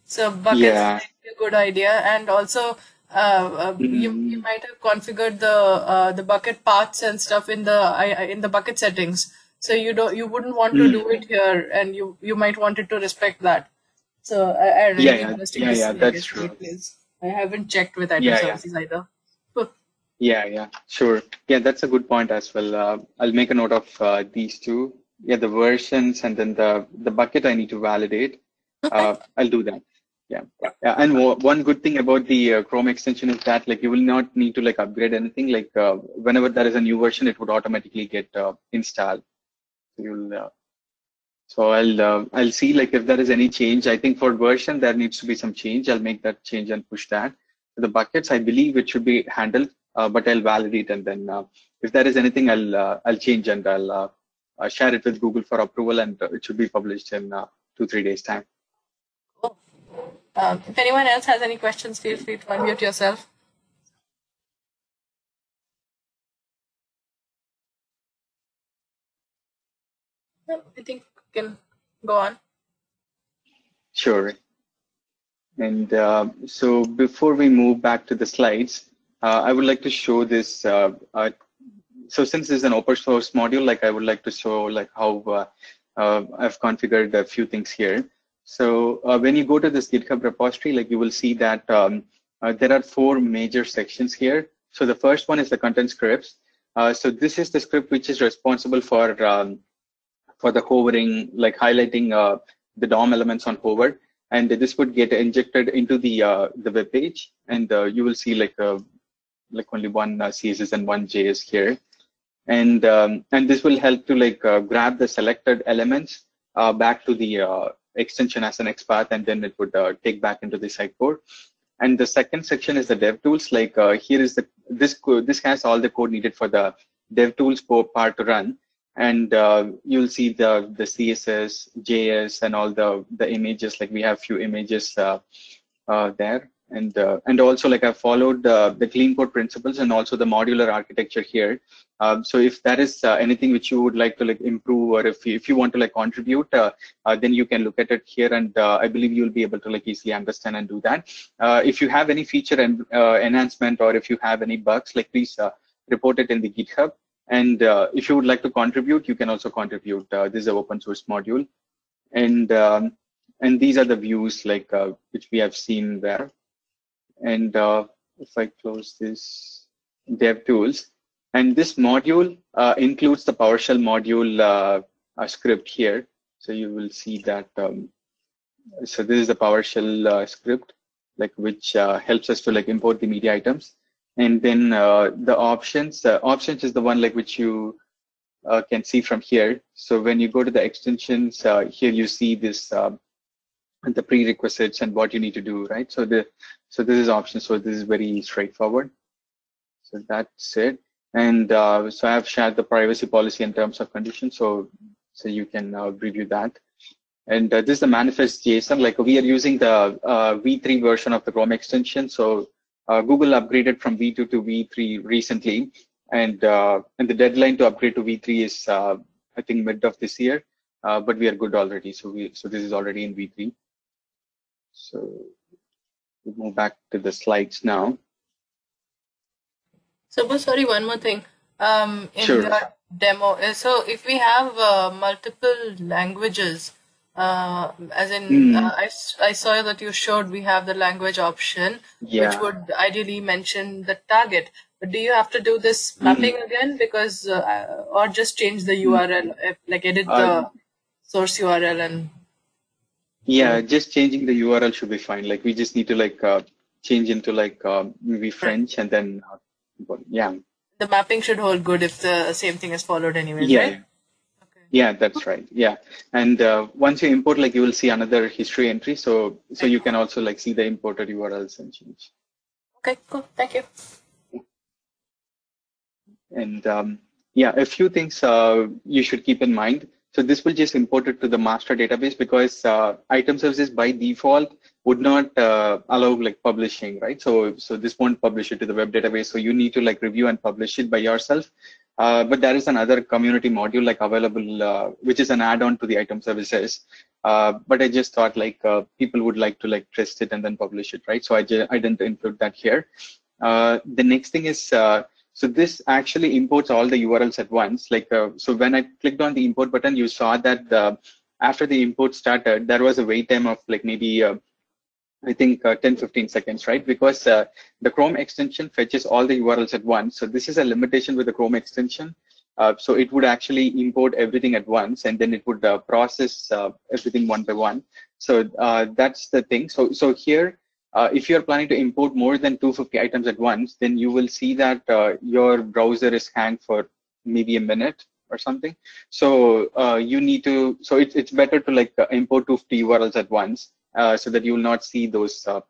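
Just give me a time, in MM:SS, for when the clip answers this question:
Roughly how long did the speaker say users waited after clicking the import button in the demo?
05:15.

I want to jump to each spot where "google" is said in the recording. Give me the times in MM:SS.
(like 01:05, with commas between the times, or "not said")
00:55, 03:33.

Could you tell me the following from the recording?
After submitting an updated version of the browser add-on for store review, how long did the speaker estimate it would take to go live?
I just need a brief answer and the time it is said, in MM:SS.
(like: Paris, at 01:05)
2-3 days, at 00:57.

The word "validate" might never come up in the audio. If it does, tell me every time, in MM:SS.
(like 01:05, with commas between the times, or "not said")
00:27, 00:50.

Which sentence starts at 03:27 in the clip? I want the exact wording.
And uh, this is the manifest JSON.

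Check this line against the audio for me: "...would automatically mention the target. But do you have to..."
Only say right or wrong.
wrong.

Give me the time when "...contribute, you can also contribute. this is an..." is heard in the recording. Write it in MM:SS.
02:38.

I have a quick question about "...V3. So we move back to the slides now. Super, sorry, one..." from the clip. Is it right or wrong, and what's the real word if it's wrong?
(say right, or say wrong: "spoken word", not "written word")
right.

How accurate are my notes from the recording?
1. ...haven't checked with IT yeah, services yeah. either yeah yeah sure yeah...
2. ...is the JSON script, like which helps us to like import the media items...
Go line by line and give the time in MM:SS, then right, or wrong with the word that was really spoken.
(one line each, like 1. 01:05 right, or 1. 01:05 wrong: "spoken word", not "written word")
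1. 00:17 right
2. 02:59 wrong: "PowerShell", not "JSON".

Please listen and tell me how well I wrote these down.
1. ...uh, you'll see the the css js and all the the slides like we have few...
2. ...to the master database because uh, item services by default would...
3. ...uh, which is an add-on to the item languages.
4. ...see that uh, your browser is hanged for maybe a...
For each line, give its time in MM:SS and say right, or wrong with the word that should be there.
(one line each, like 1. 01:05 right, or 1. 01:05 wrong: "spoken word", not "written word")
1. 02:09 wrong: "images", not "slides"
2. 04:41 right
3. 04:54 wrong: "services", not "languages"
4. 05:34 right.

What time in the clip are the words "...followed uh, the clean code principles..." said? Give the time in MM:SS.
02:17.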